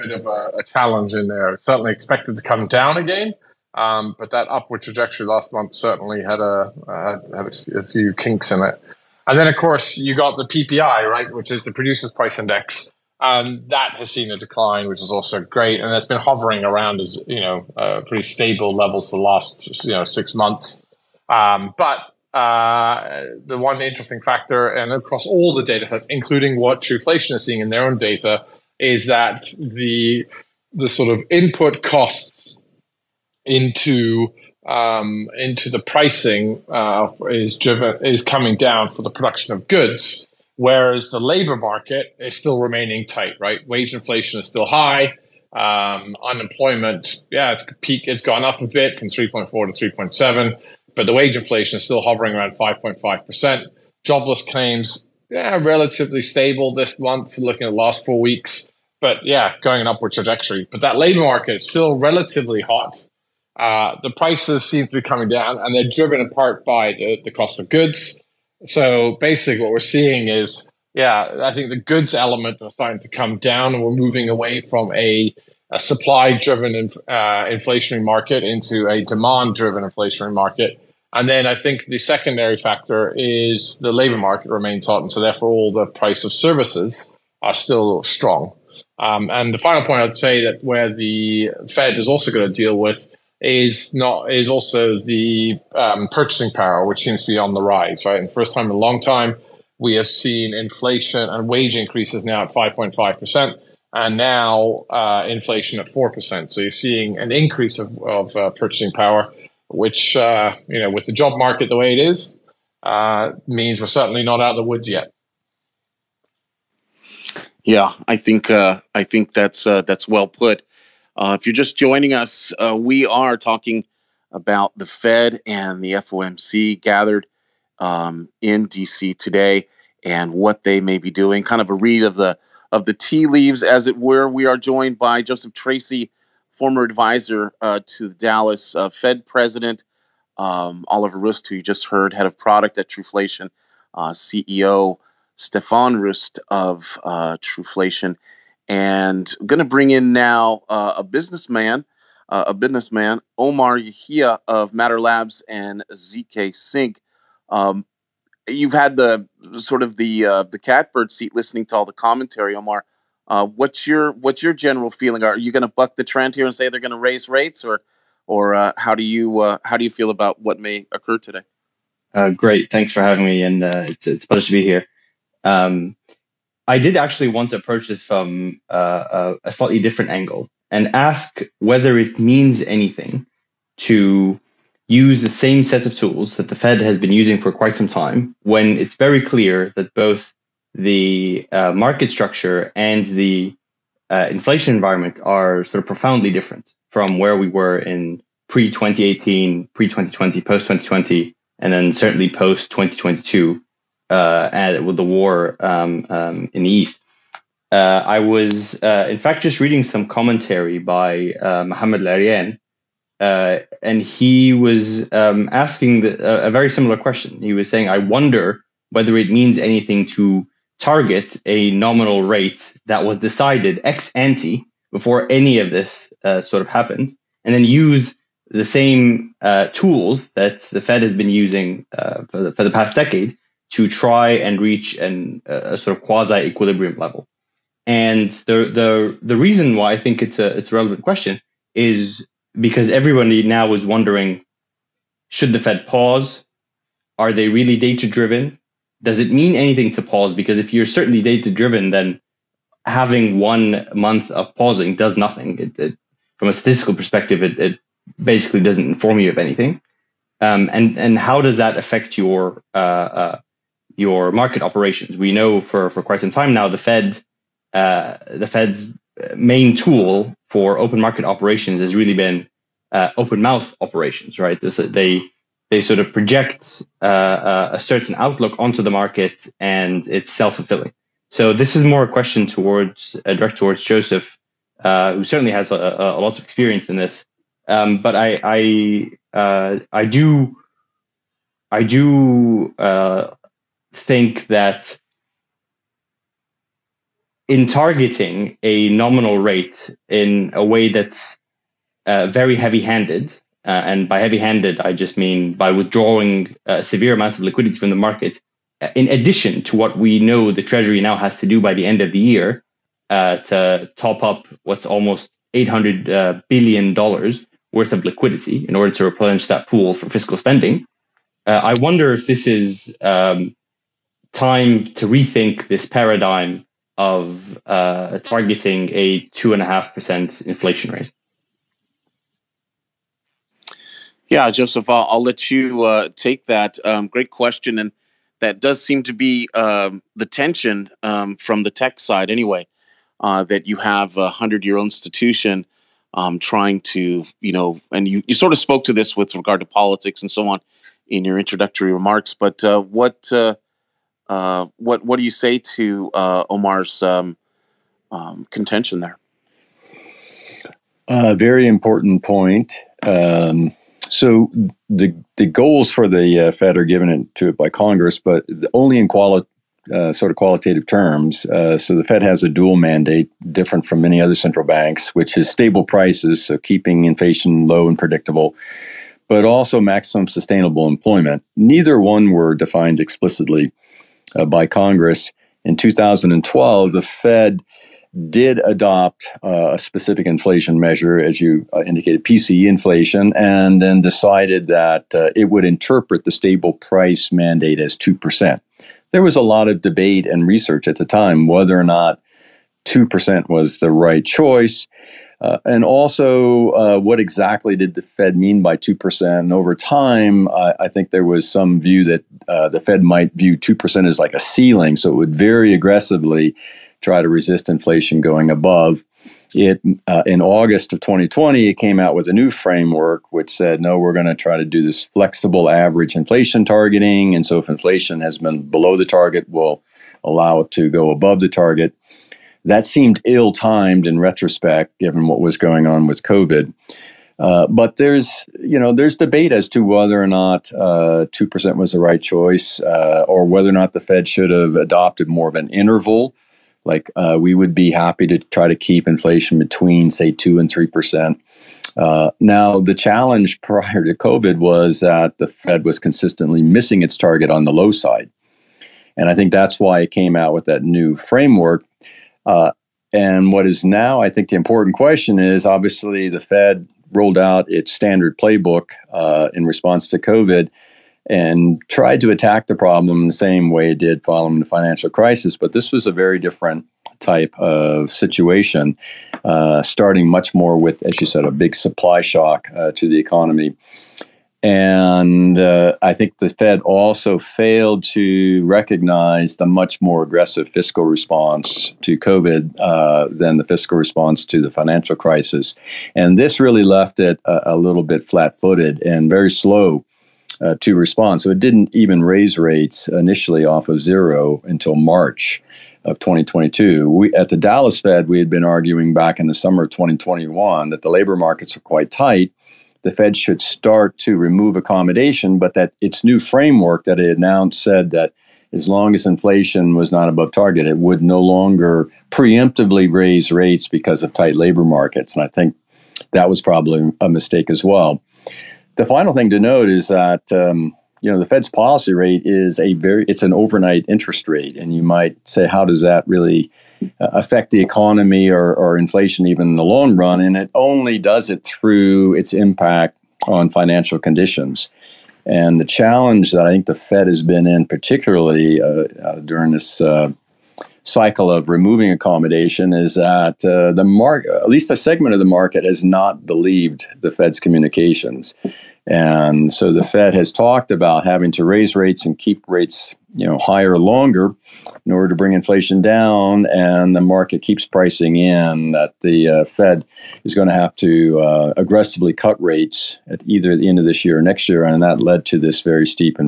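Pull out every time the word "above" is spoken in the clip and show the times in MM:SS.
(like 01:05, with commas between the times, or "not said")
06:58, 07:11, 08:40.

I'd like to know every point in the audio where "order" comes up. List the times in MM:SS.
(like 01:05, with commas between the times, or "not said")
05:18, 09:25.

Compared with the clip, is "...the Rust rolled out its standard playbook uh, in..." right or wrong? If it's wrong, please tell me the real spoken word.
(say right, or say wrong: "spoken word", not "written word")
wrong: "Fed", not "Rust".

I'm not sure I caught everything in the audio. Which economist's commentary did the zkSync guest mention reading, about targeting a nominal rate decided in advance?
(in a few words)
Mohamed El-Erian.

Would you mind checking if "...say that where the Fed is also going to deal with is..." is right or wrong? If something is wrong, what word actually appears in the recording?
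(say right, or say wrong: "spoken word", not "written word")
right.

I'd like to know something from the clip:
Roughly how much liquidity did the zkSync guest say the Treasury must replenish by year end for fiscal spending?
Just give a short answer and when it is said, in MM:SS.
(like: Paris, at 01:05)
$800 billion, at 05:15.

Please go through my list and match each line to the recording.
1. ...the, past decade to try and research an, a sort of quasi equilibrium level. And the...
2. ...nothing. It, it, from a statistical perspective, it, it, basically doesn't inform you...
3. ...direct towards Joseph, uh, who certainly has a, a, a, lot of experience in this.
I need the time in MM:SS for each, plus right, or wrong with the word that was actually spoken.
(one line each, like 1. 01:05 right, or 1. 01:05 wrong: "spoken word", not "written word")
1. 03:52 wrong: "reach", not "research"
2. 04:15 right
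3. 04:43 right.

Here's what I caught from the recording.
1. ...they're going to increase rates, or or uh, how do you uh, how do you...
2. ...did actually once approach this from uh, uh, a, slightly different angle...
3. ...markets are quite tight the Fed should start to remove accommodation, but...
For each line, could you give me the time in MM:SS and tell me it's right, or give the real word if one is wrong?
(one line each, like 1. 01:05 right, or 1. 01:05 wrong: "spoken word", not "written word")
1. 02:46 wrong: "raise", not "increase"
2. 02:56 right
3. 08:31 right.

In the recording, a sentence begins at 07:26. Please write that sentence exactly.
Like uh, we would be happy to try to keep inflation between, say, two and three percent.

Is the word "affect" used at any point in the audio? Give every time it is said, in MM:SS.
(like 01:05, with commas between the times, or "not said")
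04:21, 08:57.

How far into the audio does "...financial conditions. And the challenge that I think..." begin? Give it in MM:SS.
09:03.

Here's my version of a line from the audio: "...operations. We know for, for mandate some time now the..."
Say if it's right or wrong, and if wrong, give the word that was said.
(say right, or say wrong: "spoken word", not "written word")
wrong: "quite", not "mandate".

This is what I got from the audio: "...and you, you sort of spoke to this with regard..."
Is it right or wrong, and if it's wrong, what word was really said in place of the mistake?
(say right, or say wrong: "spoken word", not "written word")
right.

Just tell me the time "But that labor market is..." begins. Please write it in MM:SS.
01:00.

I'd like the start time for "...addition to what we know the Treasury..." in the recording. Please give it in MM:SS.
05:09.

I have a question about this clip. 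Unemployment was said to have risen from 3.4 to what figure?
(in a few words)
3.7.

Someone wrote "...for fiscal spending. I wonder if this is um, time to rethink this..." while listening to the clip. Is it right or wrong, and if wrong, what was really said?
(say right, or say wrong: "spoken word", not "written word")
right.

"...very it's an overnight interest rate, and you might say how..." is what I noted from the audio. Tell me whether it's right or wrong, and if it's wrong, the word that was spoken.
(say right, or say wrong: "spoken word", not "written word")
right.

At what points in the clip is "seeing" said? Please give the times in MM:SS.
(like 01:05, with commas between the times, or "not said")
00:27, 01:09, 01:46.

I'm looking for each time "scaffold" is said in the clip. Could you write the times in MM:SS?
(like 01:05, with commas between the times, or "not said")
not said.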